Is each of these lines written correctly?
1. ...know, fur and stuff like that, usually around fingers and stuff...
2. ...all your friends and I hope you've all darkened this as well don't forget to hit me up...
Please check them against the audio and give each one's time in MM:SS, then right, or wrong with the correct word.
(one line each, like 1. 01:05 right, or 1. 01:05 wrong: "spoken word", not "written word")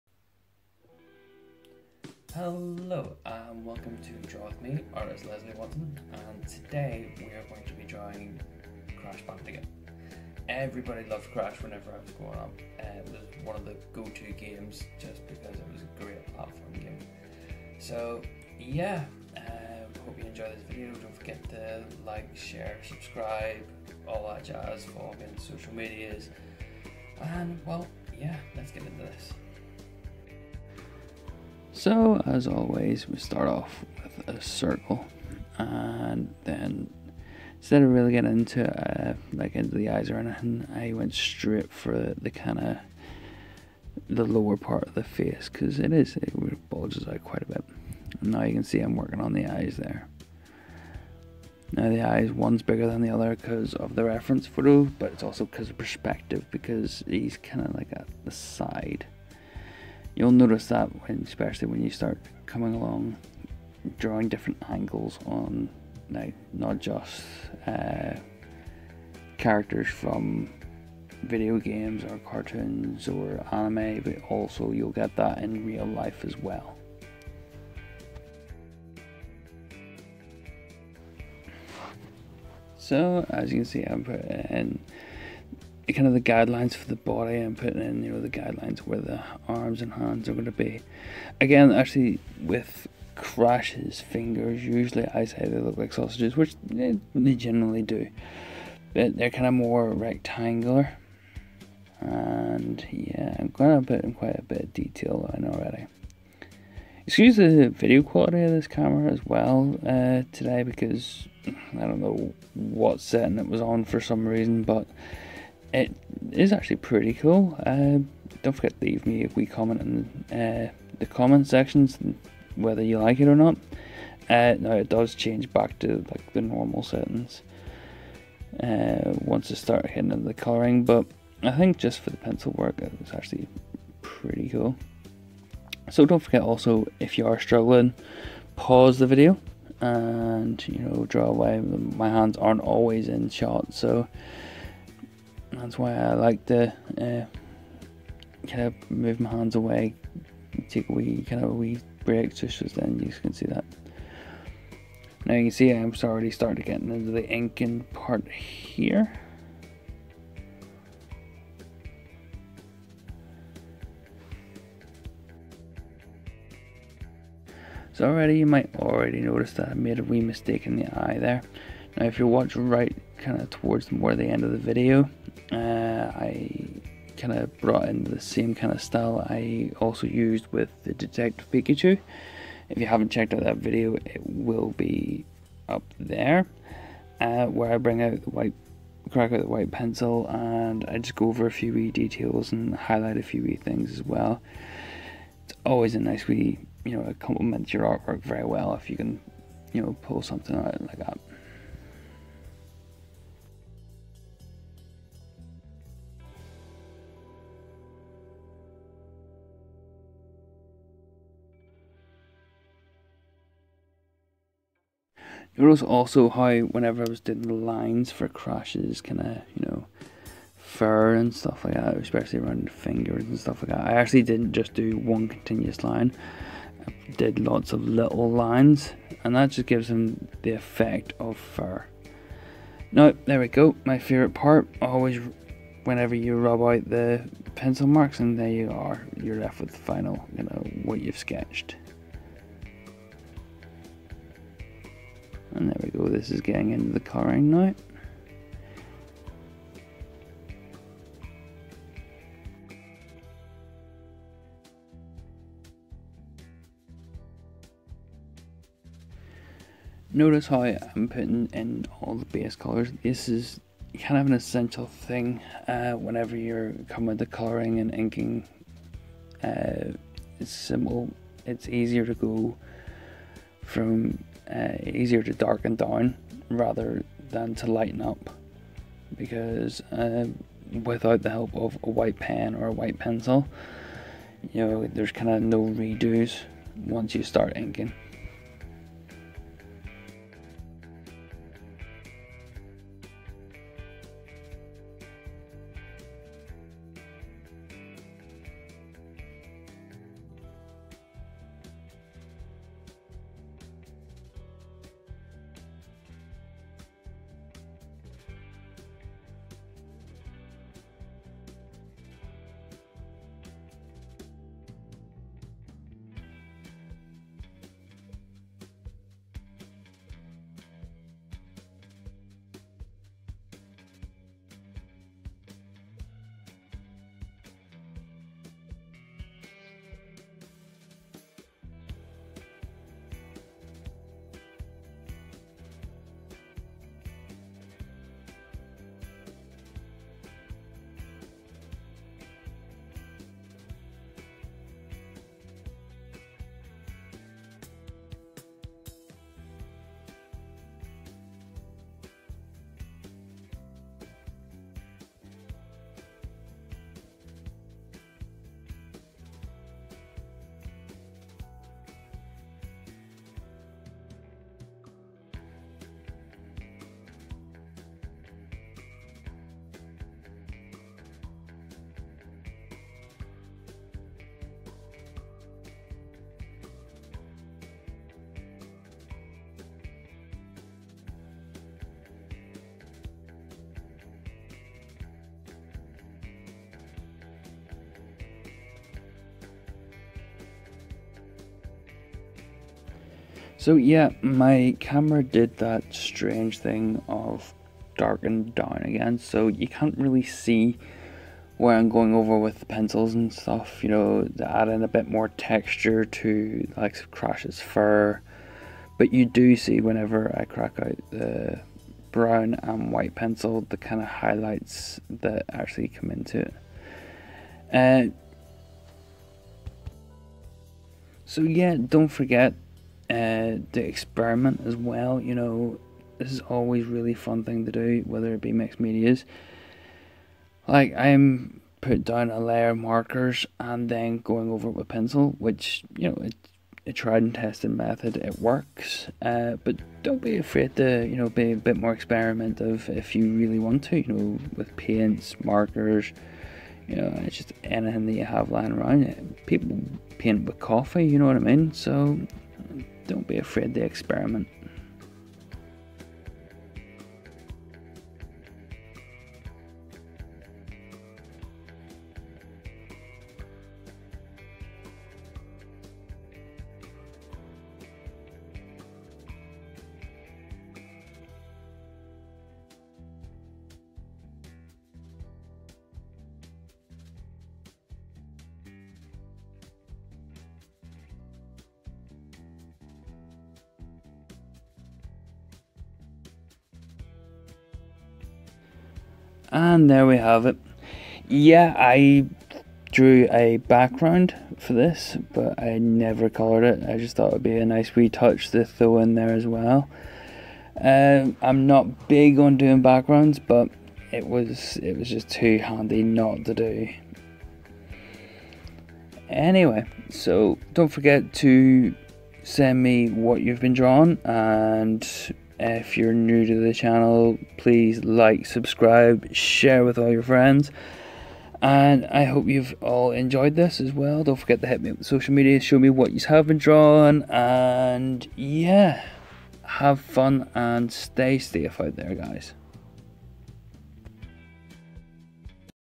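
1. 03:39 wrong: "especially", not "usually"
2. 08:39 wrong: "enjoyed", not "darkened".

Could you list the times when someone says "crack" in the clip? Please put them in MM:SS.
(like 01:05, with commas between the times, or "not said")
03:09, 06:50.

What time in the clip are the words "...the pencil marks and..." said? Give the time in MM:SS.
03:56.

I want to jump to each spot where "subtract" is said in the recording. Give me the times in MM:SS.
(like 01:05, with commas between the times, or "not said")
not said.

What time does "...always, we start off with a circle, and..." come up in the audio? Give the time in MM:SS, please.
00:32.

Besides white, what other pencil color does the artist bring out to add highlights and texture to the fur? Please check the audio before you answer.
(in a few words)
Brown.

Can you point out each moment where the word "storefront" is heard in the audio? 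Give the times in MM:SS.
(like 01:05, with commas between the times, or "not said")
not said.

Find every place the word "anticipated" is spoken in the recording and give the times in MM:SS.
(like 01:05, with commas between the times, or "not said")
not said.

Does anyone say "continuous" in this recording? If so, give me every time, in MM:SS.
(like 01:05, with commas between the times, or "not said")
03:45.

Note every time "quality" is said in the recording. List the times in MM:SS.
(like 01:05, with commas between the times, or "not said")
01:48.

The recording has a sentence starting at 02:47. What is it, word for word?
So already you might already notice that I made a wee mistake in the eye there.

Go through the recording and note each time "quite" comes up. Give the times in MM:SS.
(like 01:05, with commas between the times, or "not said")
00:47, 01:44.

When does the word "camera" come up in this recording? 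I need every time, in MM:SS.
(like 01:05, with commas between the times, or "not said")
01:48, 06:34.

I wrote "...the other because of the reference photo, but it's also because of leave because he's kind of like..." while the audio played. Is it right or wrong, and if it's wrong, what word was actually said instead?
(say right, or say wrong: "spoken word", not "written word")
wrong: "perspective", not "leave".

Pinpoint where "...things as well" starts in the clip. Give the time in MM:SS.
03:13.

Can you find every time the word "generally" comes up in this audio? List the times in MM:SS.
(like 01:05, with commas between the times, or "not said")
01:37.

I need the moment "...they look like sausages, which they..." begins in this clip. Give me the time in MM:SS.
01:35.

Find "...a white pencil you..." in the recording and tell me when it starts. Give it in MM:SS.
04:42.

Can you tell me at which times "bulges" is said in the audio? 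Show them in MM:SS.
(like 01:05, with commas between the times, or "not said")
00:46.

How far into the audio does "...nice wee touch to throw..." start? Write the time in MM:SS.
08:17.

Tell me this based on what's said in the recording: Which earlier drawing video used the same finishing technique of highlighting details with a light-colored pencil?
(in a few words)
Detective Pikachu.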